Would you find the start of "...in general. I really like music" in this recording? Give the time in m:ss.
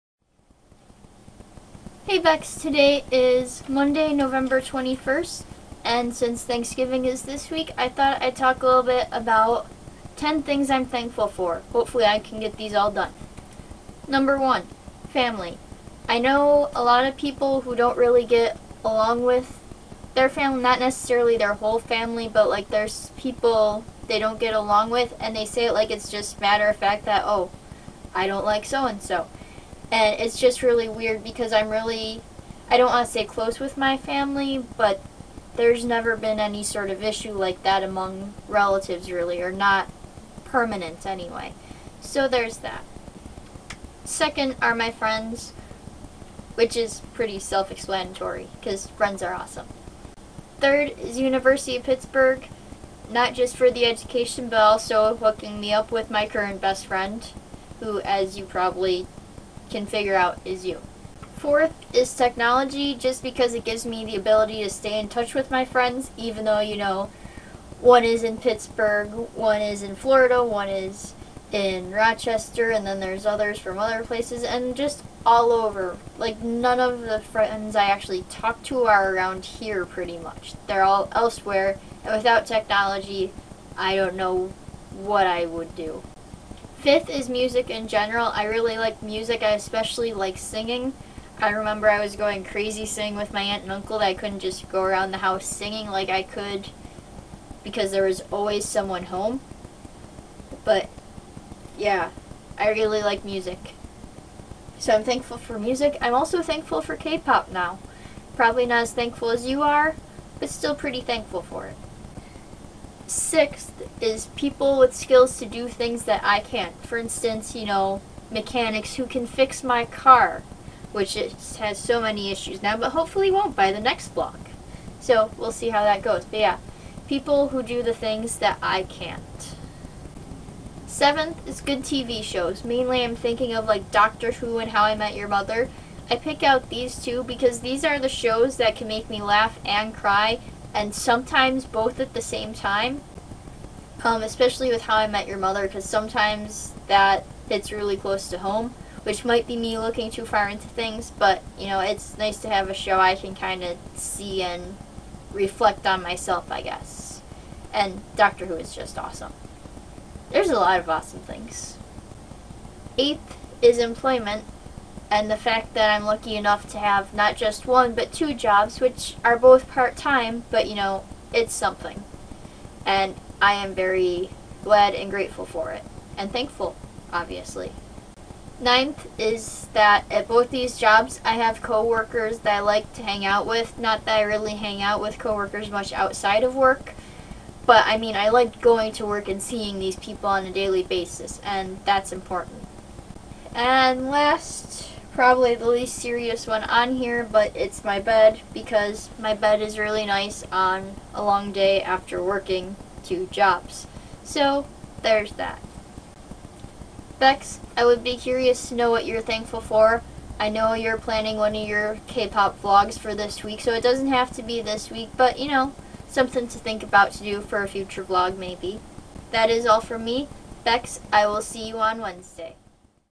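1:27.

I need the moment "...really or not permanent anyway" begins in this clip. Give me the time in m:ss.
0:39.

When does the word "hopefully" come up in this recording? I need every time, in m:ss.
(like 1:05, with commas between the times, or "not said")
0:11, 2:02.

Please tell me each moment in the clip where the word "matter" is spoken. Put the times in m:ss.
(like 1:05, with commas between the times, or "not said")
0:26.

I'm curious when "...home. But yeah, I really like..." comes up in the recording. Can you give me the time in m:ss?
1:39.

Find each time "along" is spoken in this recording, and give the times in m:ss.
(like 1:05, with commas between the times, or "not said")
0:18, 0:24.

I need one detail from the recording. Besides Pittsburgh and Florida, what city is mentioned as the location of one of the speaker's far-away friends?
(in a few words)
Rochester.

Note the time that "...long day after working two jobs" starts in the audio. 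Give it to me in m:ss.
3:21.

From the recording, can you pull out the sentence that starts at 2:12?
Mainly I'm thinking of like Doctor Who and How I Met Your Mother.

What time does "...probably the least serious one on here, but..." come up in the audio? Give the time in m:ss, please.
3:15.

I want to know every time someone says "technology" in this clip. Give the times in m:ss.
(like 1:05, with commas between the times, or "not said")
1:02, 1:22.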